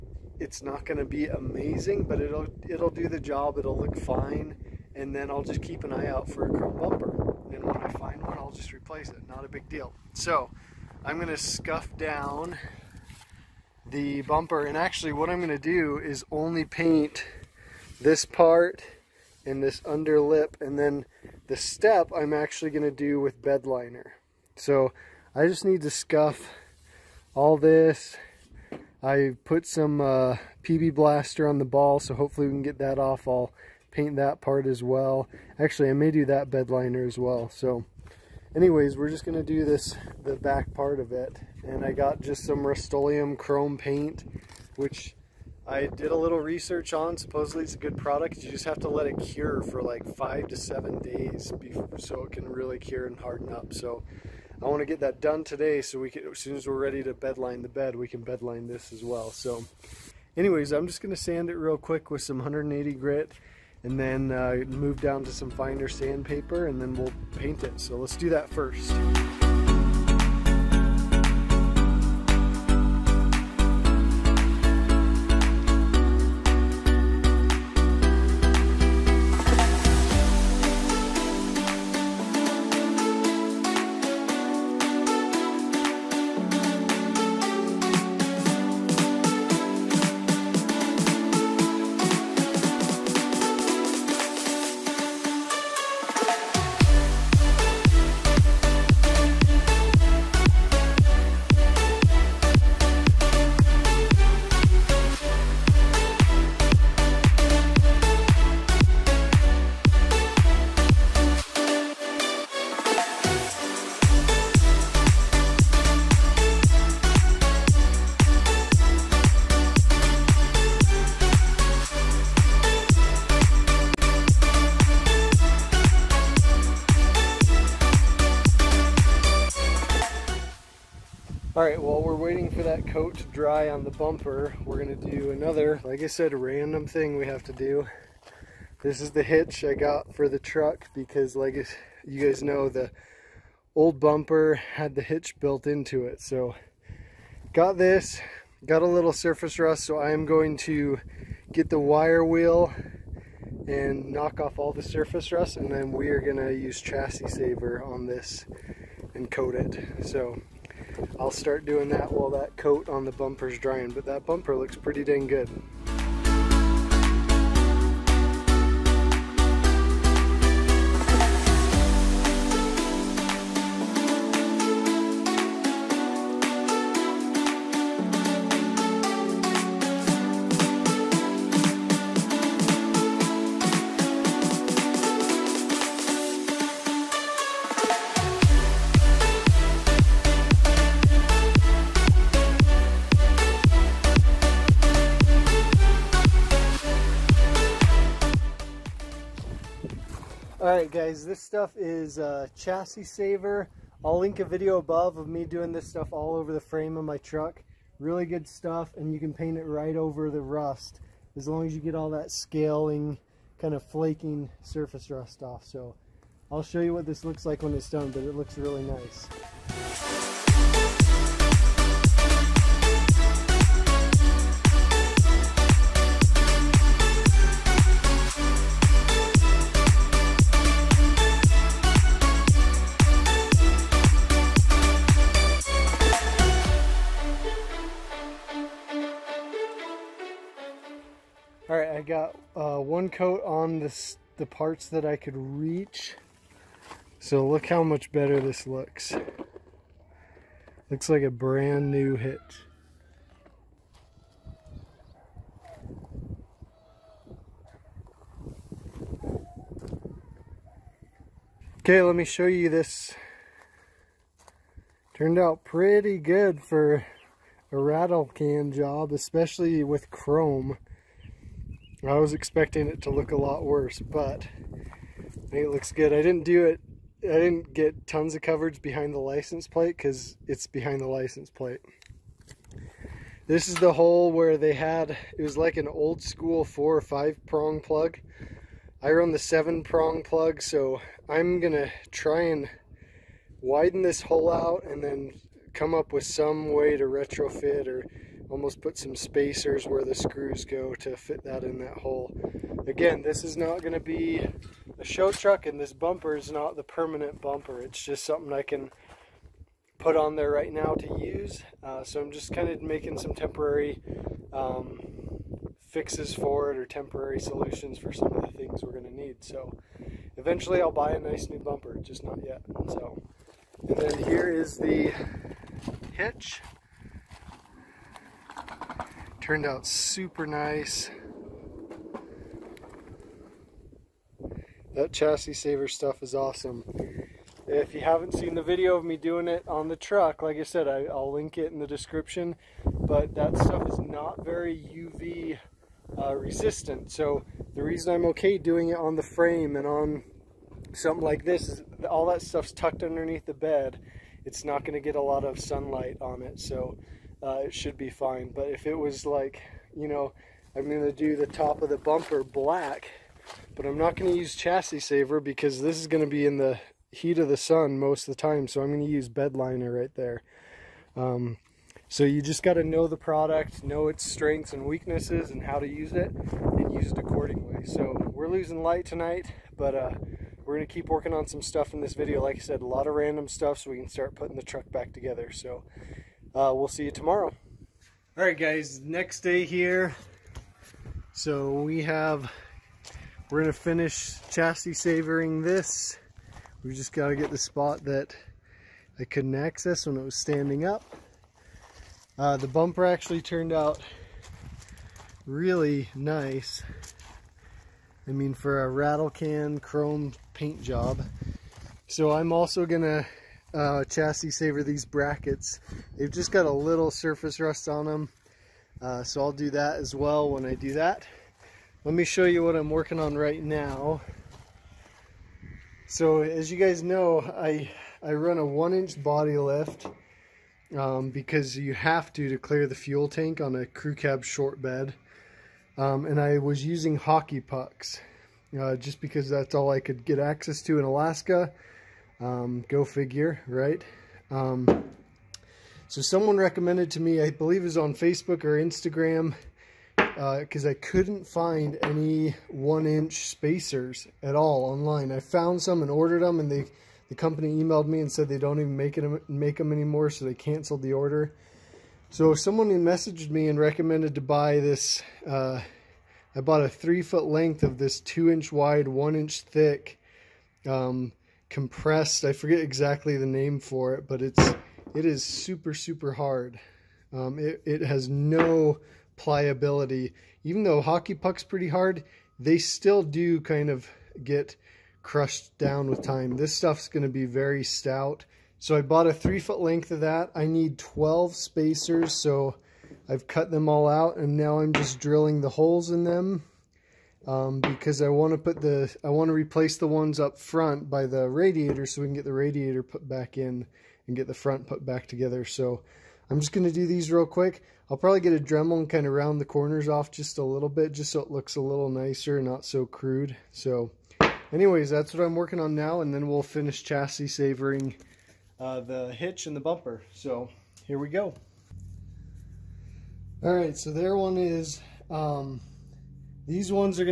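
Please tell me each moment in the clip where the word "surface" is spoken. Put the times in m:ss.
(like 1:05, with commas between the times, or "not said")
2:29, 2:34, 3:34, 6:57.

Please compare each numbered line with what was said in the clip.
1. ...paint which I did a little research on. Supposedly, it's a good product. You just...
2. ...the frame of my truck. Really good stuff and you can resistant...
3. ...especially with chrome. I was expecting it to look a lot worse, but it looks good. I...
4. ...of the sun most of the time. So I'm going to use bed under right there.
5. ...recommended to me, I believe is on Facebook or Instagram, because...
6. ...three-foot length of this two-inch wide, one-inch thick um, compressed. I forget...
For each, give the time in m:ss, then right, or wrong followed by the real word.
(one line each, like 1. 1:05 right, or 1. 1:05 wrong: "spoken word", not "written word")
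1. 0:43 right
2. 3:26 wrong: "paint", not "resistant"
3. 4:29 right
4. 6:07 wrong: "liner", not "under"
5. 7:26 right
6. 7:46 right.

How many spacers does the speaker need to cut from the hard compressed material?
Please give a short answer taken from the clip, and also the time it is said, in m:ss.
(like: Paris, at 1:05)
12, at 8:10.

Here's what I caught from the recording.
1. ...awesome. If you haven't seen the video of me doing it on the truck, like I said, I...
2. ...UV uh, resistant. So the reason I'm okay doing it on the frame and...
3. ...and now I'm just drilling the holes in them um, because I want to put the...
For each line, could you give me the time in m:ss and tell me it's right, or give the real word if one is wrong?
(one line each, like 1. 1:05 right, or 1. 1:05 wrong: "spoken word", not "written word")
1. 5:36 right
2. 5:44 right
3. 8:14 right.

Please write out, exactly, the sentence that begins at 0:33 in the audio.
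I'll paint that part as well.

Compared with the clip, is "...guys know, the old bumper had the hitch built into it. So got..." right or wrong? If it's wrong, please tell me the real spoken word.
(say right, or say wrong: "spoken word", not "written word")
right.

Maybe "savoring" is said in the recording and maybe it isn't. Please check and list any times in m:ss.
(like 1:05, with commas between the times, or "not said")
6:34, 8:37.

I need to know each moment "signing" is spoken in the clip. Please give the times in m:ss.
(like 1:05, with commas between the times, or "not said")
not said.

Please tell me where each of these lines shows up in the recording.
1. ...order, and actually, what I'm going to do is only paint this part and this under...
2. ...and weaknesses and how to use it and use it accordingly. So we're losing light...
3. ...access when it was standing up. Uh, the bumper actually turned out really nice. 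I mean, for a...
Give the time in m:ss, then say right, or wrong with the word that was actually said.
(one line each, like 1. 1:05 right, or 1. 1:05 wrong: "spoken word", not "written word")
1. 0:14 wrong: "bumper", not "order"
2. 6:14 right
3. 6:39 right.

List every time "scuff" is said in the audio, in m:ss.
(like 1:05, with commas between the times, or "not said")
0:11, 0:25.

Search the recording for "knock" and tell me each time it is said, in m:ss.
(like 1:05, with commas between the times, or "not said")
2:34.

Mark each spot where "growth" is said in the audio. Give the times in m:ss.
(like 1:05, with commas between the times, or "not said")
not said.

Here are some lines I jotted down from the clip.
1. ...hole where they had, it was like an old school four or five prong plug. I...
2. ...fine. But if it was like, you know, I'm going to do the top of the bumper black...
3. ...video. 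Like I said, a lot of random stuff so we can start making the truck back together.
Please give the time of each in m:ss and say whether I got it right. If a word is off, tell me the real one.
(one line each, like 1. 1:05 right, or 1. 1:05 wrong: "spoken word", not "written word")
1. 4:43 right
2. 5:58 right
3. 6:22 wrong: "putting", not "making".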